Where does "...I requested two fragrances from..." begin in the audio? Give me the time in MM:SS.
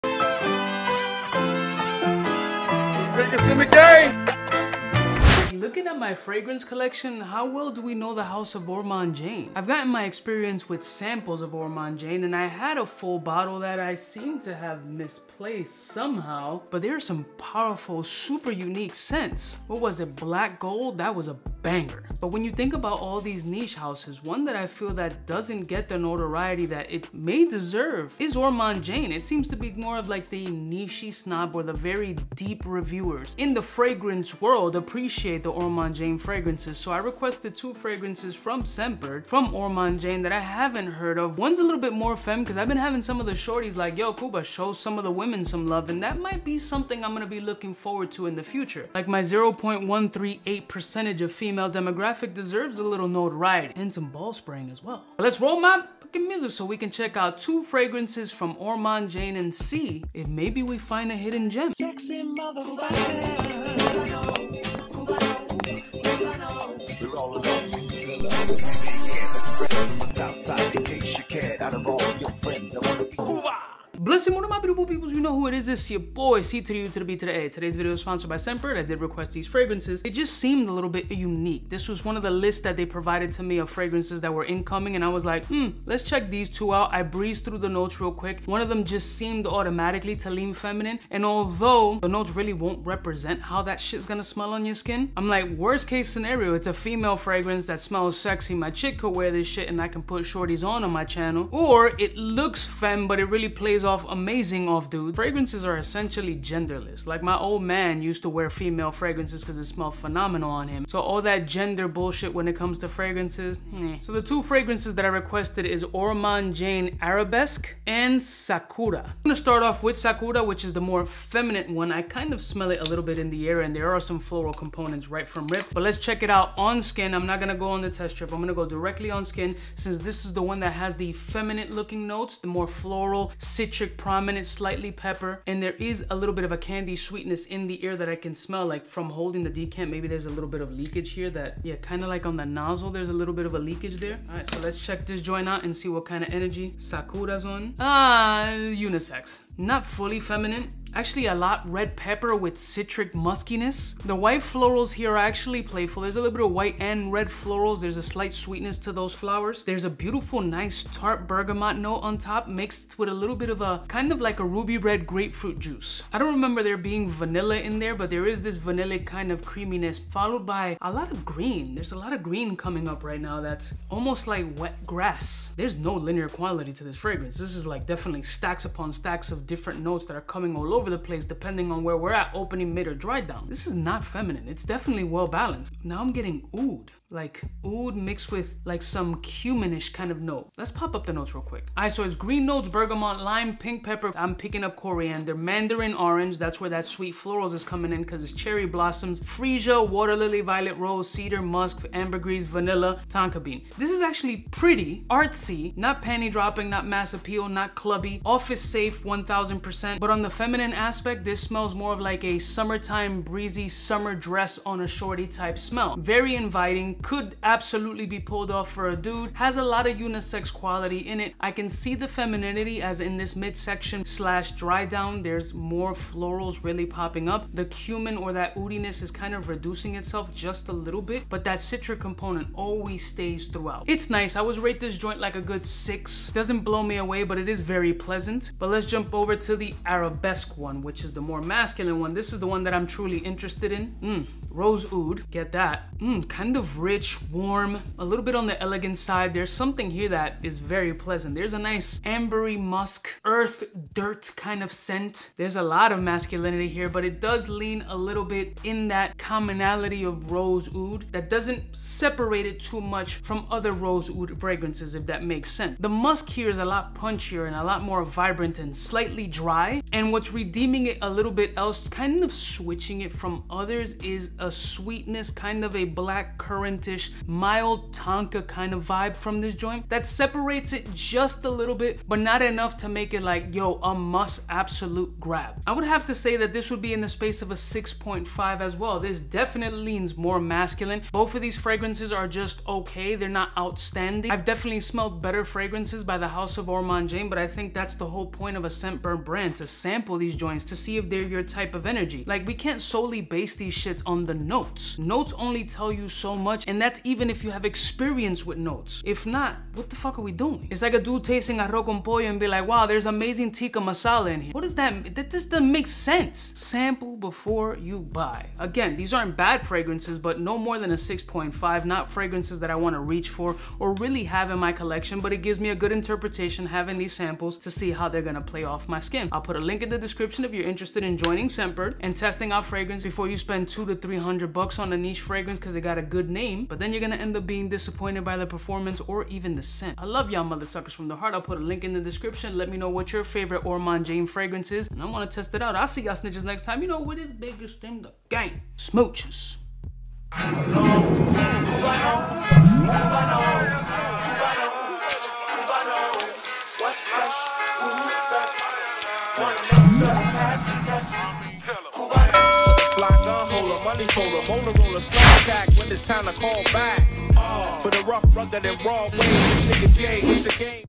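00:36.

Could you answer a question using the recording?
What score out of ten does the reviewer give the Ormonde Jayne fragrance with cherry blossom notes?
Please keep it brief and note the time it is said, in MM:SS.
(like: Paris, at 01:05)
6, at 03:55.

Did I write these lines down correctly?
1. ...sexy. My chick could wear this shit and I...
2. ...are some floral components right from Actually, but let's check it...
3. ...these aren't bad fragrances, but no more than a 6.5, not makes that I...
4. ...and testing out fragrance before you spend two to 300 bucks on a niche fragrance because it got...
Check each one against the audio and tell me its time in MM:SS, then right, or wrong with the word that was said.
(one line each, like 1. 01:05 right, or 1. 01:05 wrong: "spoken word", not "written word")
1. 01:38 right
2. 02:03 wrong: "Rip", not "Actually"
3. 05:18 wrong: "fragrances", not "makes"
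4. 05:32 right.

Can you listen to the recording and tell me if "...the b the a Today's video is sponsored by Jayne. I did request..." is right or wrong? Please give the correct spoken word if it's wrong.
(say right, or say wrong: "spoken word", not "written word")
wrong: "Scentbird", not "Jayne".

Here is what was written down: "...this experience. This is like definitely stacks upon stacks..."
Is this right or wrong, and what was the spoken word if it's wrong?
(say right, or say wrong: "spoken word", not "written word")
wrong: "fragrance", not "experience".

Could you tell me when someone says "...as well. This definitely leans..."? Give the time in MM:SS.
04:48.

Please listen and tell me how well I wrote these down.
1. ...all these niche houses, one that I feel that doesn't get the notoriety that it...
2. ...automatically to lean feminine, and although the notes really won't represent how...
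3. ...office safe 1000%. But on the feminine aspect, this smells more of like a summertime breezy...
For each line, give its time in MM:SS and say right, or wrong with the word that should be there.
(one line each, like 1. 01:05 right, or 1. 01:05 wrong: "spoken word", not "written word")
1. 00:22 right
2. 01:29 right
3. 03:28 right.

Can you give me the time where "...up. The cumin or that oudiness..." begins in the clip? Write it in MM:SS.
03:47.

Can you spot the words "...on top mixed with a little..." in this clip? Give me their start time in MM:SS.
02:42.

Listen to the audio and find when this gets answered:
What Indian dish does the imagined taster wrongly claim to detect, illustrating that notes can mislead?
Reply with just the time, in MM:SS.
05:13.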